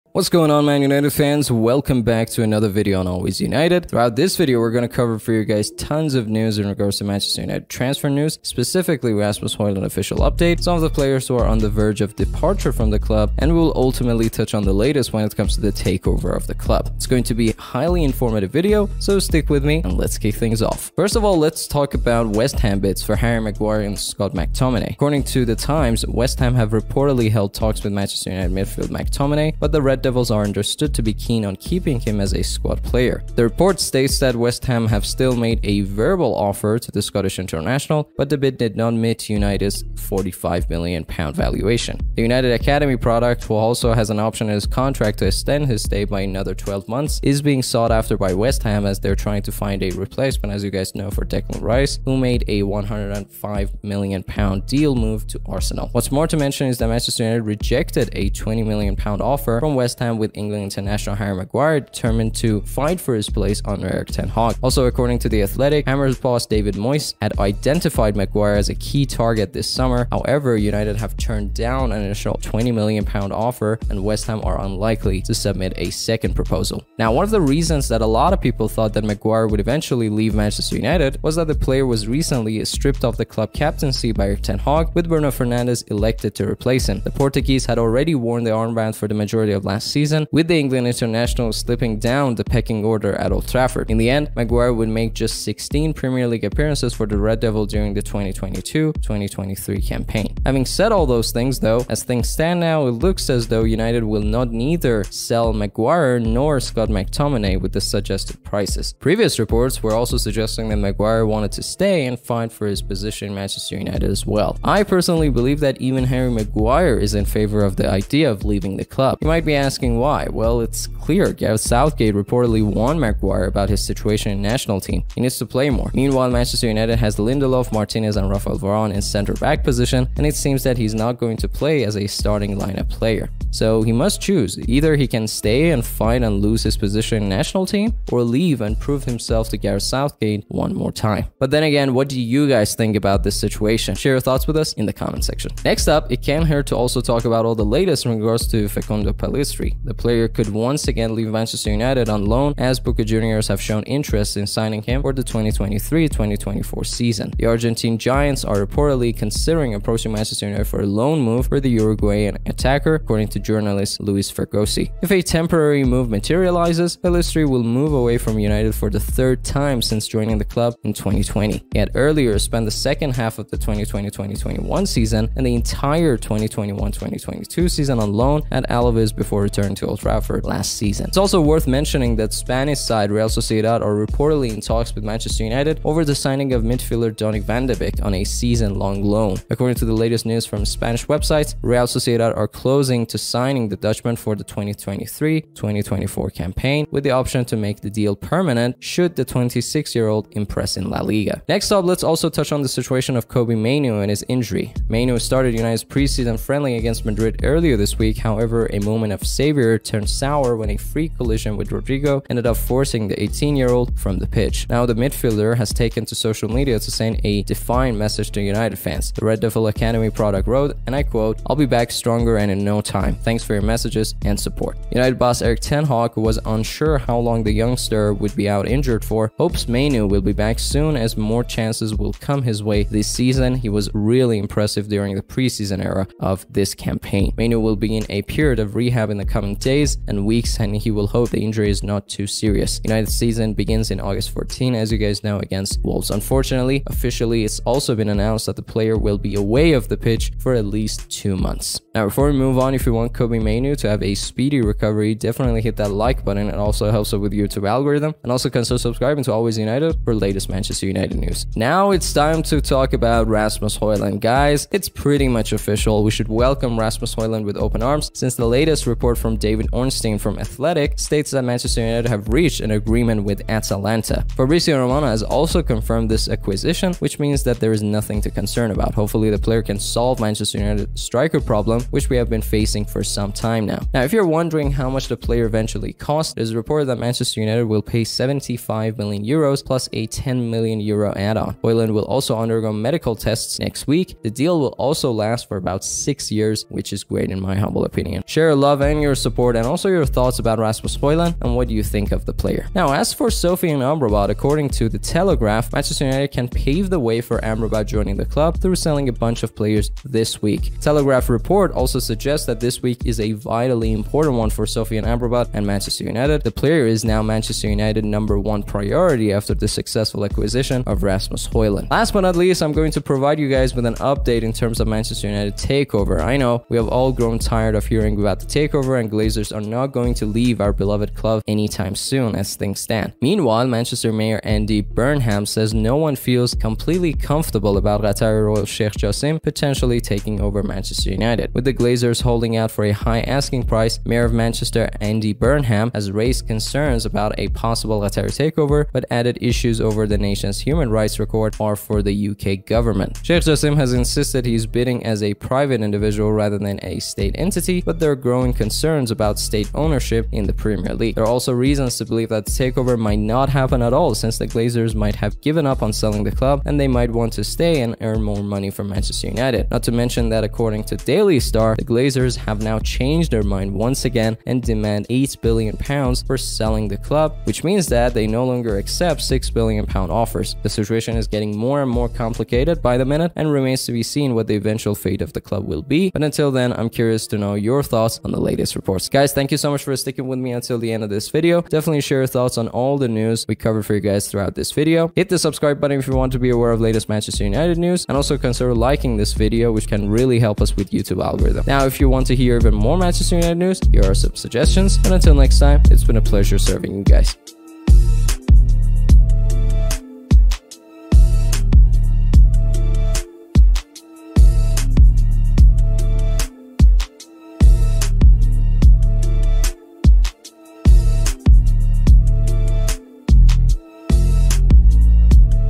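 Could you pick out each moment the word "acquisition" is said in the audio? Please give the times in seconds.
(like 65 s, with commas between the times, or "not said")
276 s, 320 s.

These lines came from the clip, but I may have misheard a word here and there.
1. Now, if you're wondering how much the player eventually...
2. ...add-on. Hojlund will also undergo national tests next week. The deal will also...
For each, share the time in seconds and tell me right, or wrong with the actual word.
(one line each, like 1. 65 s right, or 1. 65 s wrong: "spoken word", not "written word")
1. 283 s right
2. 291 s wrong: "medical", not "national".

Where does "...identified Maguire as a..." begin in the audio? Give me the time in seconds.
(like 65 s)
67 s.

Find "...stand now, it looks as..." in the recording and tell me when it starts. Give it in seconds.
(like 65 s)
102 s.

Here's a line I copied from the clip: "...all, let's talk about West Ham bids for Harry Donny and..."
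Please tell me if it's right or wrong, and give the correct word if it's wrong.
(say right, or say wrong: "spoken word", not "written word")
wrong: "Maguire", not "Donny".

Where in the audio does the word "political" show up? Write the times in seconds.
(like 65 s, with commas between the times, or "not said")
not said.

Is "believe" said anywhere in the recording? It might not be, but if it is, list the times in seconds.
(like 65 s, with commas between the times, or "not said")
115 s, 362 s.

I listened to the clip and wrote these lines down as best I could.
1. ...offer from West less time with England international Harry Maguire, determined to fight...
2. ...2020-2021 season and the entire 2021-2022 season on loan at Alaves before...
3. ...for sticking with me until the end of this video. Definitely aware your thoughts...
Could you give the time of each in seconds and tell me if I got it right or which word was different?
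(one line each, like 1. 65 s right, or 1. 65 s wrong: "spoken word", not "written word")
1. 59 s right
2. 173 s right
3. 389 s wrong: "share", not "aware".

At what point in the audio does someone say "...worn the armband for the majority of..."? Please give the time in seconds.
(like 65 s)
88 s.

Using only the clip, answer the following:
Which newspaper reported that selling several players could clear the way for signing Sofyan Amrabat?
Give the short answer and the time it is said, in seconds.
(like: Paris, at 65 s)
The Telegraph, at 304 s.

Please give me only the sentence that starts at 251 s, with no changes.
Now before we move on, if you want Kobbie Mainoo to have a speedy recovery, definitely hit that like button.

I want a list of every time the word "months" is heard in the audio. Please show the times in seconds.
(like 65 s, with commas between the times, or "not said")
46 s, 251 s.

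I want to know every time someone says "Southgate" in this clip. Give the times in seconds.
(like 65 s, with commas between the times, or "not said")
121 s, 139 s.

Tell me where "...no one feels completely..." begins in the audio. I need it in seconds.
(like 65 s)
335 s.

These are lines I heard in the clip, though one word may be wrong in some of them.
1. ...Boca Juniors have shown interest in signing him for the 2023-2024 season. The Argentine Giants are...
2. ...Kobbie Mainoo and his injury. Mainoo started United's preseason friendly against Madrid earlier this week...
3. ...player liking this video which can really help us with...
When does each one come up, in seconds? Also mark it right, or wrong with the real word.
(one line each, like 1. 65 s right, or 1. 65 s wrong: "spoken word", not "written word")
1. 152 s right
2. 203 s right
3. 398 s wrong: "consider", not "player".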